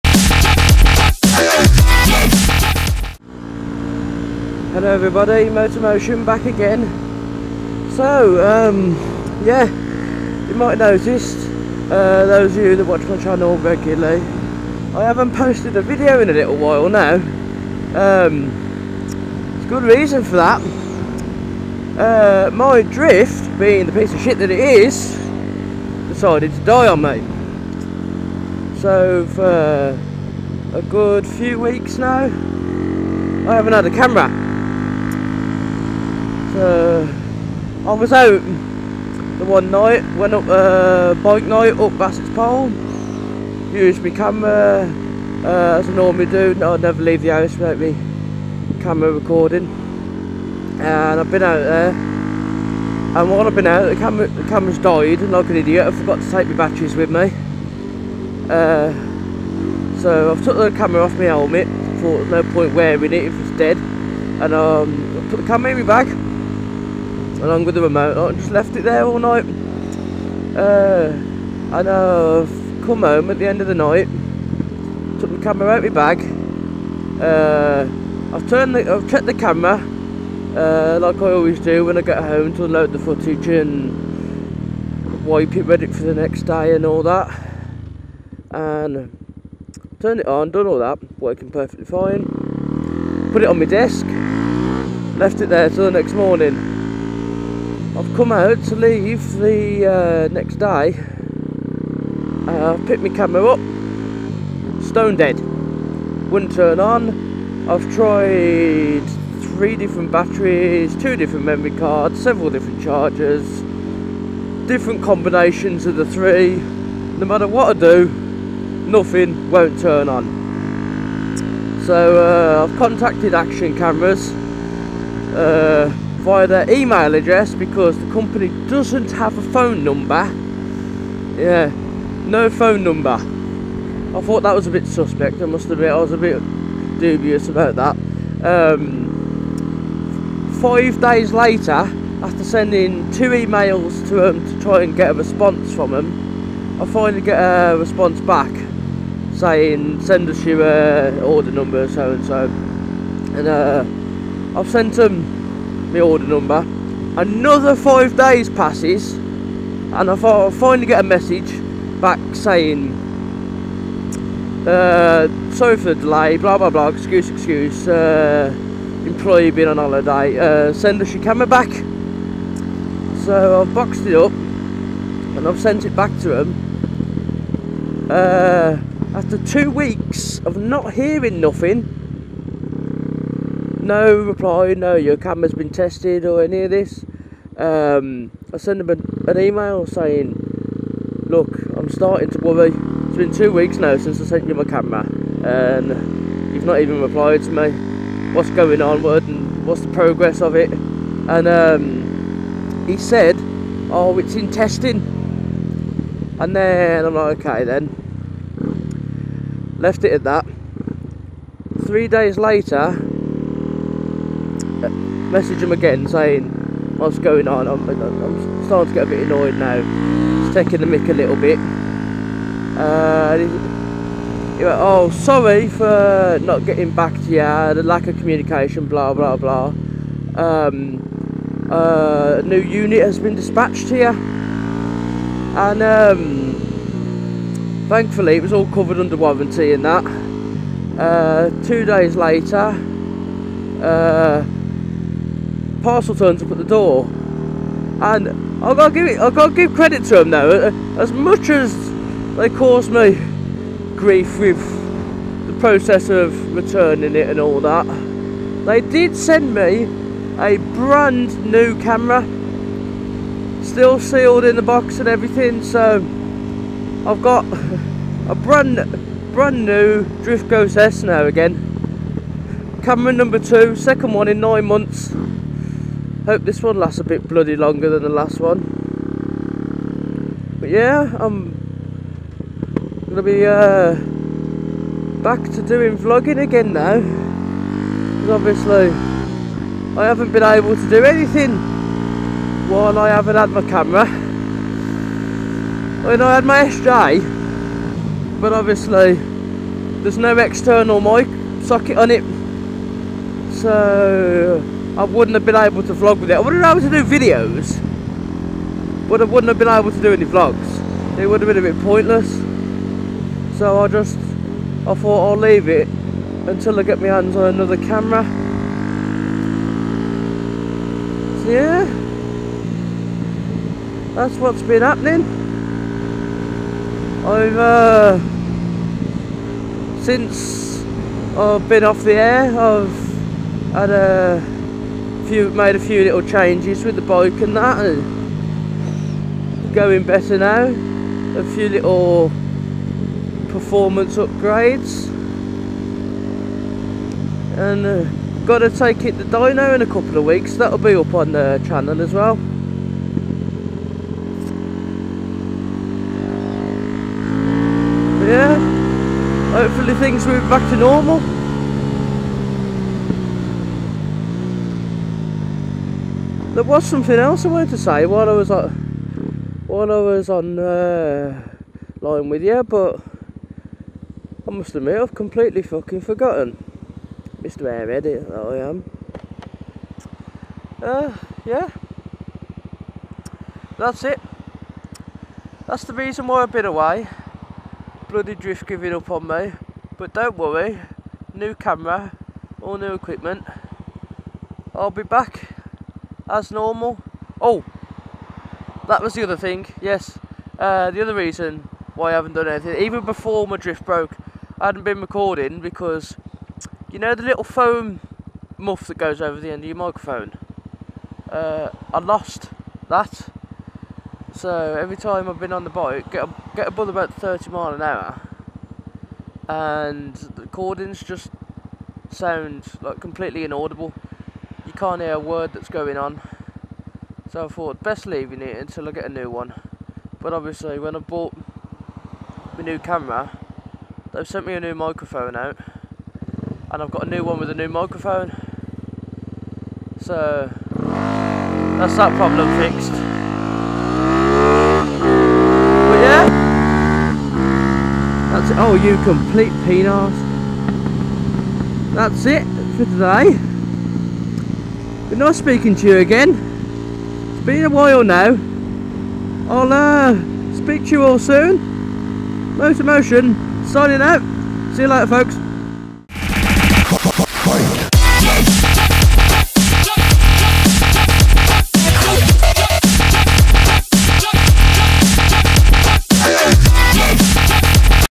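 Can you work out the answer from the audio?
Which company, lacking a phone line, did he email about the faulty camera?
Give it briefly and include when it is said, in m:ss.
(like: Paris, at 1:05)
Action Cameras, at 2:03.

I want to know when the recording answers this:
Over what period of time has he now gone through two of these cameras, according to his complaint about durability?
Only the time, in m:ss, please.
4:34.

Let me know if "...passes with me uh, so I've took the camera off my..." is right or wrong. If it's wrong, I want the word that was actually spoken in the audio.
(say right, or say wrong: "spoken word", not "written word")
wrong: "batteries", not "passes".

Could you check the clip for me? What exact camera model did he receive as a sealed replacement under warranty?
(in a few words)
Drift Ghost S.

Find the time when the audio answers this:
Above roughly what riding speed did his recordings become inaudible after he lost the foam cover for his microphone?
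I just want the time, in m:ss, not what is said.
6:57.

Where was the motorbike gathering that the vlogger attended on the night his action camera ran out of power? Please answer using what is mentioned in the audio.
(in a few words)
Bassett's Pole.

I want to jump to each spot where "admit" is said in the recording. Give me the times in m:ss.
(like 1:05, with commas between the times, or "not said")
2:15, 6:14.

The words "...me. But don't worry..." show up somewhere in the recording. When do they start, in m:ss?
6:29.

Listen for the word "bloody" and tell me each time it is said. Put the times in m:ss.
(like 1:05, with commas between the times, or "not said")
4:37, 6:28.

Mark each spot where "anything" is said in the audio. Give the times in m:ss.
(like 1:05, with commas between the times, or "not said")
4:51, 6:42.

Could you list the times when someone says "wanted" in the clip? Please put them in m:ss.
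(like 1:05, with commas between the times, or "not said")
6:07.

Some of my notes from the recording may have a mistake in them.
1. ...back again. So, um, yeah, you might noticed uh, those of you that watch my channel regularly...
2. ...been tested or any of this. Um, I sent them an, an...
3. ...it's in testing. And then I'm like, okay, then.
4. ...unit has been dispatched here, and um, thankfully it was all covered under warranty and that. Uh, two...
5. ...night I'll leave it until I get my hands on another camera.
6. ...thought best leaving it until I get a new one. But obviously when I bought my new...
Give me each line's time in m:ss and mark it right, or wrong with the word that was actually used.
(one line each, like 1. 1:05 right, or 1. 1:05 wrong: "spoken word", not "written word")
1. 0:06 right
2. 3:05 right
3. 3:24 right
4. 3:52 right
5. 5:14 wrong: "thought", not "night"
6. 7:07 right.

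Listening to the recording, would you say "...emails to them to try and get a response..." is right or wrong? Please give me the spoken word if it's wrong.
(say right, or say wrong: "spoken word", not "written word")
right.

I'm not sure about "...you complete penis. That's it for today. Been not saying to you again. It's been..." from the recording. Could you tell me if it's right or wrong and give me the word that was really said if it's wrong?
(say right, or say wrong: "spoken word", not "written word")
wrong: "speaking", not "saying".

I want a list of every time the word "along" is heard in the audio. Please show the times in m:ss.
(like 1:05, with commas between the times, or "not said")
1:07.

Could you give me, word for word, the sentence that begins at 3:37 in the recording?
I'm, I'm starting to get a bit annoyed now.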